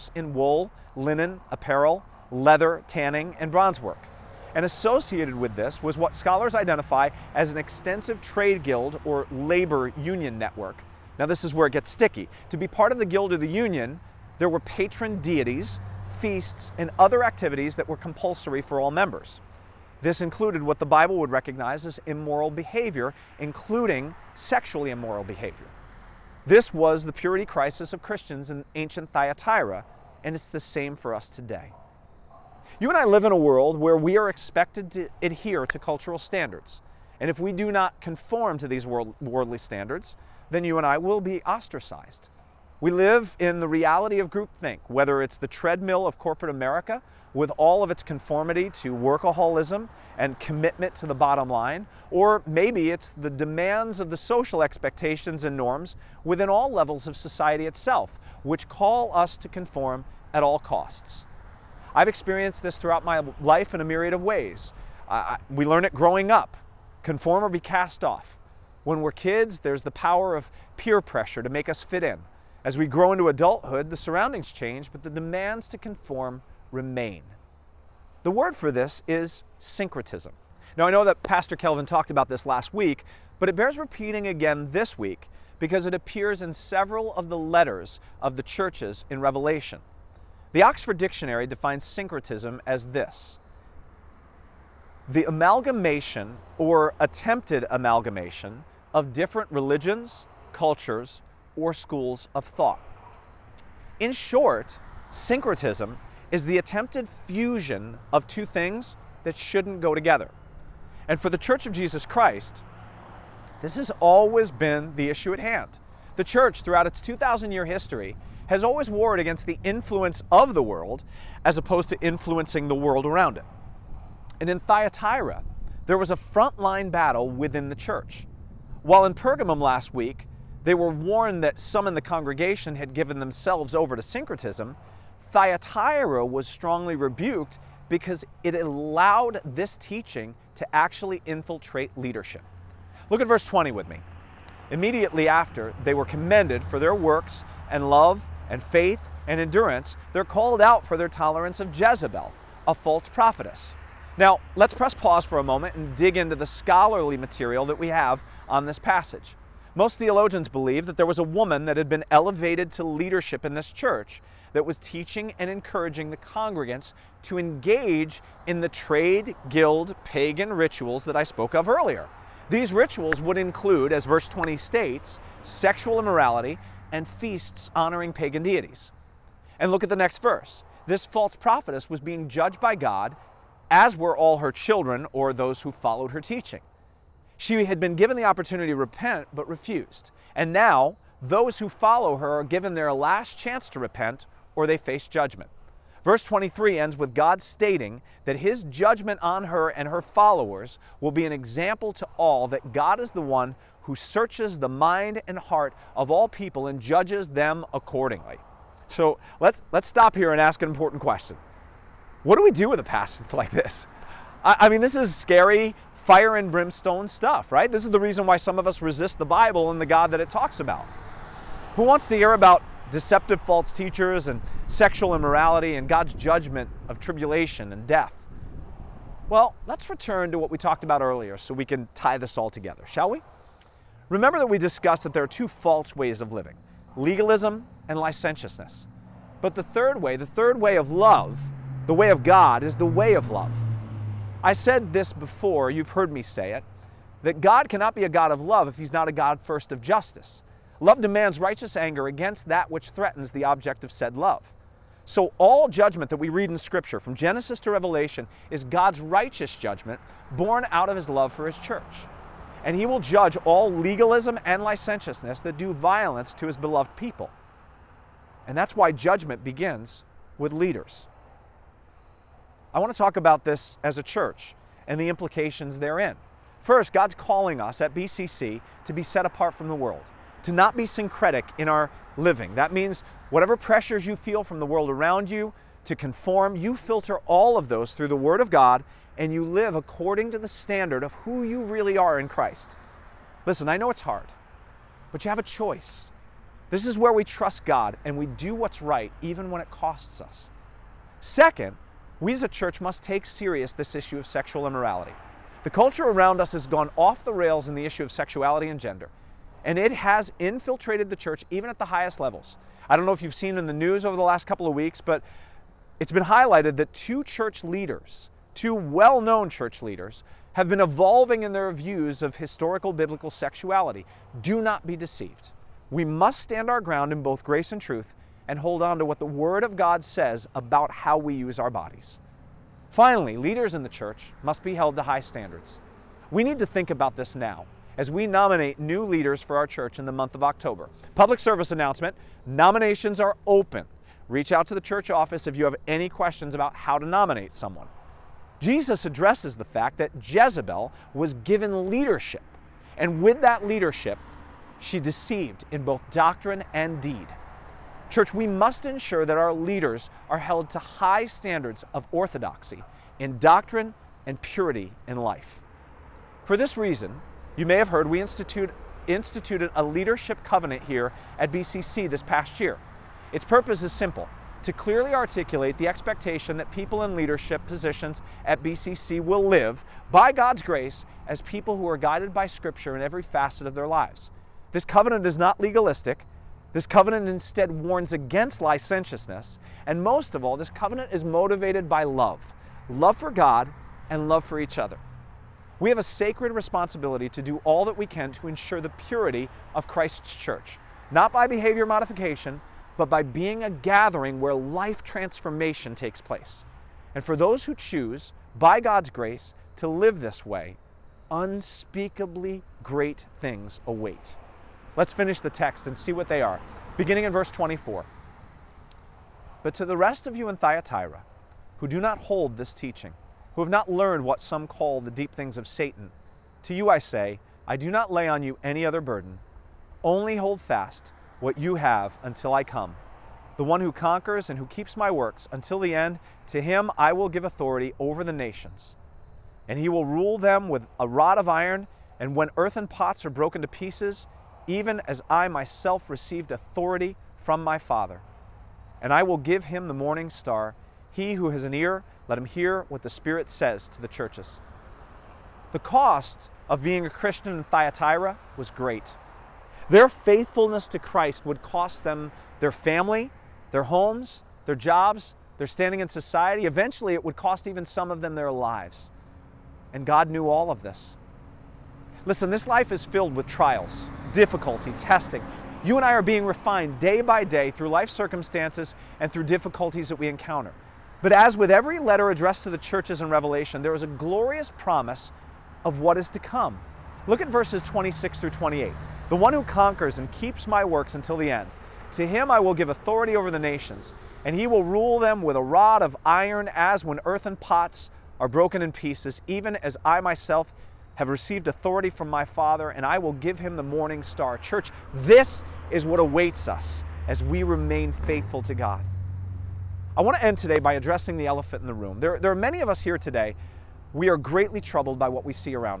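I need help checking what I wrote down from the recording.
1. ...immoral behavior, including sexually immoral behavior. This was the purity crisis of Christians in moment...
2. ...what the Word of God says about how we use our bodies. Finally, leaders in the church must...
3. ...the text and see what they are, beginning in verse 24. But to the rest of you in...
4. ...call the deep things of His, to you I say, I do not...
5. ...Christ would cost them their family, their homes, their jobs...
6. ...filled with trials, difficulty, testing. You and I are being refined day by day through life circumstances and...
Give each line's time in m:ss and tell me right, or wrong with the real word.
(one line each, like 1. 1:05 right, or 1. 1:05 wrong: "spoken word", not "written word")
1. 0:22 wrong: "ancient", not "moment"
2. 5:29 right
3. 6:55 right
4. 7:04 wrong: "Satan", not "His"
5. 7:40 right
6. 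7:53 right.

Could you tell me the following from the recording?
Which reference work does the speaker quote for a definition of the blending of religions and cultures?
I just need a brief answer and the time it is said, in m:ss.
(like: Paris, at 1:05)
Oxford Dictionary, at 1:30.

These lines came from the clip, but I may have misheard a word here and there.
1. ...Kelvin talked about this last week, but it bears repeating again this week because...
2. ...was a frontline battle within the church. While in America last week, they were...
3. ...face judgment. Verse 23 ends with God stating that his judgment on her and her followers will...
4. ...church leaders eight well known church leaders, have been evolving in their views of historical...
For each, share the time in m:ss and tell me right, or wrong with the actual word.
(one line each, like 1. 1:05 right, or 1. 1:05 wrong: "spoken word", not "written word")
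1. 1:21 right
2. 2:05 wrong: "Pergamum", not "America"
3. 3:14 right
4. 5:17 wrong: "two", not "eight".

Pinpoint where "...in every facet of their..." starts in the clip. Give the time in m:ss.
6:22.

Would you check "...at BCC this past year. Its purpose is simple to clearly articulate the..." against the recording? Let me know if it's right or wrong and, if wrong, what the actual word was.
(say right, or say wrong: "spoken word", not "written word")
right.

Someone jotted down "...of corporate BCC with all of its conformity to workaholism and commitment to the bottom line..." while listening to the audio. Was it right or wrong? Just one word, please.
wrong.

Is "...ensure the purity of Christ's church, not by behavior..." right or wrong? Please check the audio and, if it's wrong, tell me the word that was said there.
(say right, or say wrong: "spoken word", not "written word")
right.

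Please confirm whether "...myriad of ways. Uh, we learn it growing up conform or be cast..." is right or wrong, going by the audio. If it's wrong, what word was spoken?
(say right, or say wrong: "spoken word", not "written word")
right.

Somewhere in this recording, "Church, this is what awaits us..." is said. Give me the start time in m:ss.
8:24.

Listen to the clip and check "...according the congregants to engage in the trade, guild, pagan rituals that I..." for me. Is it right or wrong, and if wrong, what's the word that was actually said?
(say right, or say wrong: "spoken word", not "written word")
wrong: "encouraging", not "according".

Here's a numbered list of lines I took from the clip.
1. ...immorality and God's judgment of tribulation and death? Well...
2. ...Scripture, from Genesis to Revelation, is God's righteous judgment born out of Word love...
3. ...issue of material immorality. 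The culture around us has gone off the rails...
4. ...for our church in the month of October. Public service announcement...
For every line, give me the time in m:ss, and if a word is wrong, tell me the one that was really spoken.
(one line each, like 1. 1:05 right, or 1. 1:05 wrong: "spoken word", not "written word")
1. 3:45 right
2. 4:16 wrong: "His", not "Word"
3. 5:03 wrong: "sexual", not "material"
4. 5:39 right.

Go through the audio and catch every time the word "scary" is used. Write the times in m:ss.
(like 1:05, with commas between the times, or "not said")
3:35.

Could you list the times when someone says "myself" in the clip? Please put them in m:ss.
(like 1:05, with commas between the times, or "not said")
7:25, 8:20.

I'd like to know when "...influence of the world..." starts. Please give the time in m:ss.
1:59.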